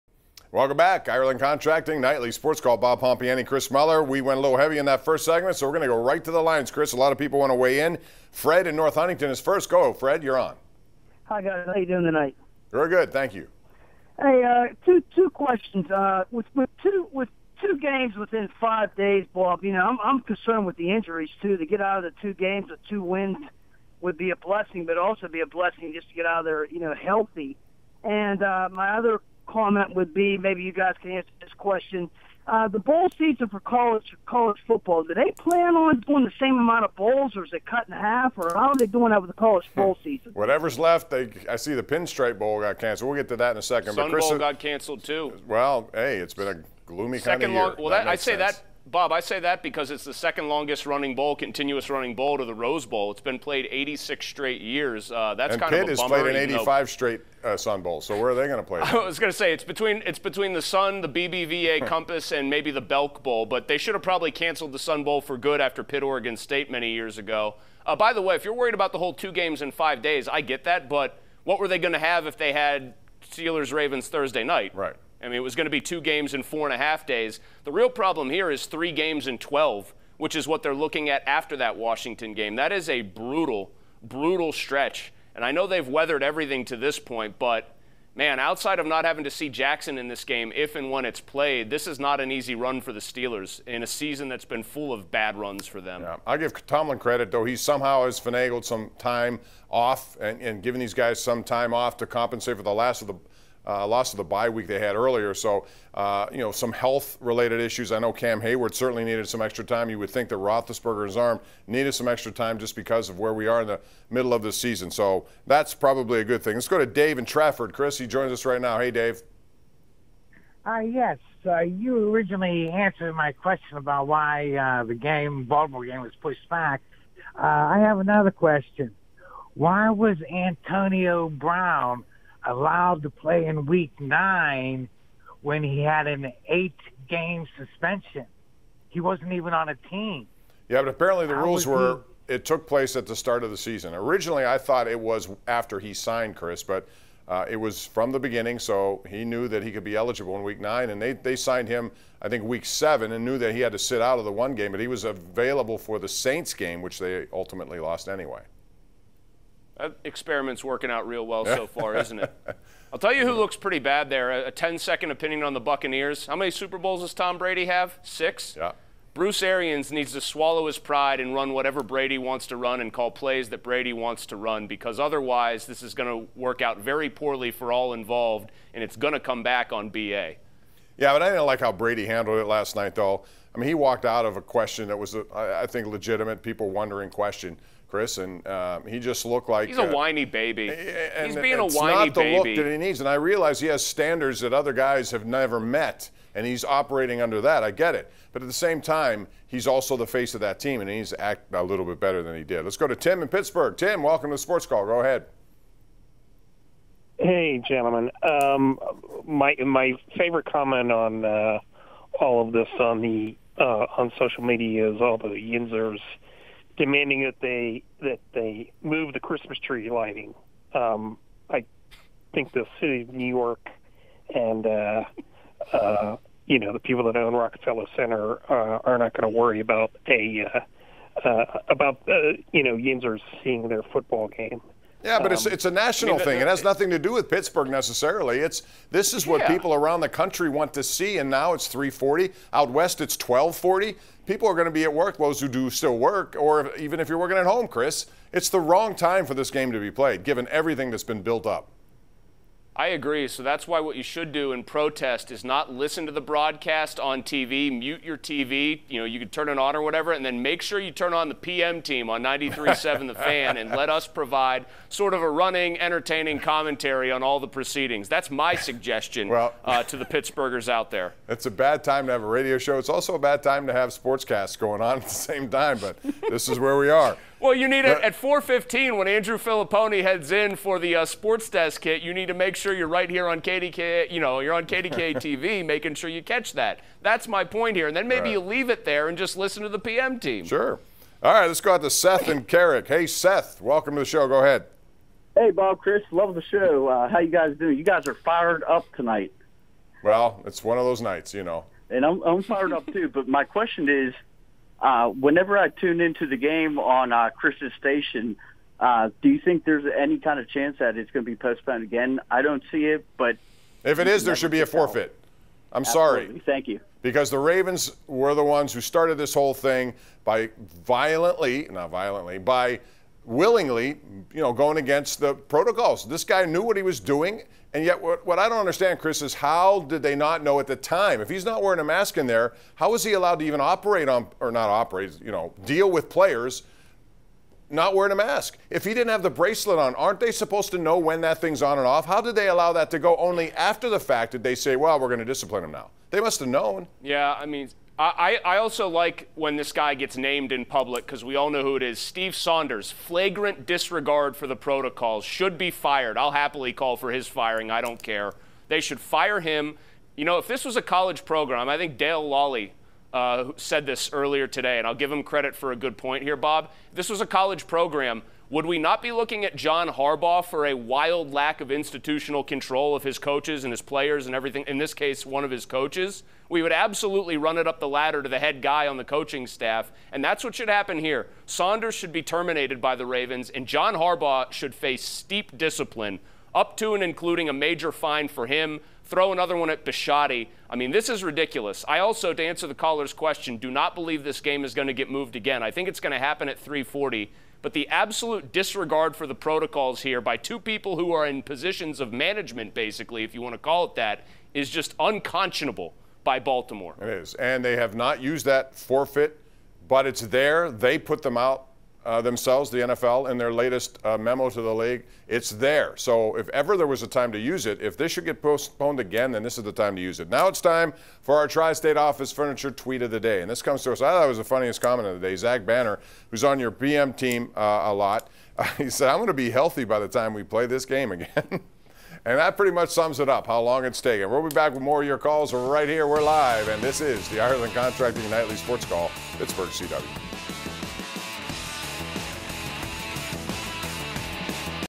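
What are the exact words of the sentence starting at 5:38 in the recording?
If he didn't have the bracelet on, aren't they supposed to know when that thing's on and off?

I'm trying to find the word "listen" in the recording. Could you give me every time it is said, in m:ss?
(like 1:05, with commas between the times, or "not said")
4:15, 4:49.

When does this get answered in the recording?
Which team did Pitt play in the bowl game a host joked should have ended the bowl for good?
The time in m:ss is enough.
1:06.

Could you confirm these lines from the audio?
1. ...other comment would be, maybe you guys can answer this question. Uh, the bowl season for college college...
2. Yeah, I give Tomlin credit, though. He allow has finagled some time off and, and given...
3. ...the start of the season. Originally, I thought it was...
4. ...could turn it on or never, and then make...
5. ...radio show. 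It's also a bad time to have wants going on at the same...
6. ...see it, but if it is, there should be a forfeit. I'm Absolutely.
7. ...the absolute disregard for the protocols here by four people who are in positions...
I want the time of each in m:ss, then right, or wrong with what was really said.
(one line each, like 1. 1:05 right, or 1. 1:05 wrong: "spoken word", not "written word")
1. 0:28 right
2. 1:36 wrong: "somehow", not "allow"
3. 2:23 right
4. 4:19 wrong: "whatever", not "never"
5. 4:32 wrong: "sportscasts", not "wants"
6. 5:12 right
7. 6:37 wrong: "two", not "four".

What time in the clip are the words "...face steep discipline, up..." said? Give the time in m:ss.
6:24.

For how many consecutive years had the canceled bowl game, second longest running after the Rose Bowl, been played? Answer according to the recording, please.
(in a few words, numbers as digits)
86.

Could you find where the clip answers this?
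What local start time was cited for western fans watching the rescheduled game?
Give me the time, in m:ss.
4:03.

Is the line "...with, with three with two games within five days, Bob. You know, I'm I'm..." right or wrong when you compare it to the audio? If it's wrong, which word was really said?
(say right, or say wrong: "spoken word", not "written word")
wrong: "two", not "three".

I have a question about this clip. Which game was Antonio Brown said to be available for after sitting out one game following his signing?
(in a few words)
the Saints game.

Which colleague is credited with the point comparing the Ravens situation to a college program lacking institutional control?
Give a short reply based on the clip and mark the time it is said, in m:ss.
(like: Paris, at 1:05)
Dale Lolley, at 6:01.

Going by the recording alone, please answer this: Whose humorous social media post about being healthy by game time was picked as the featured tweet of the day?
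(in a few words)
Zach Banner.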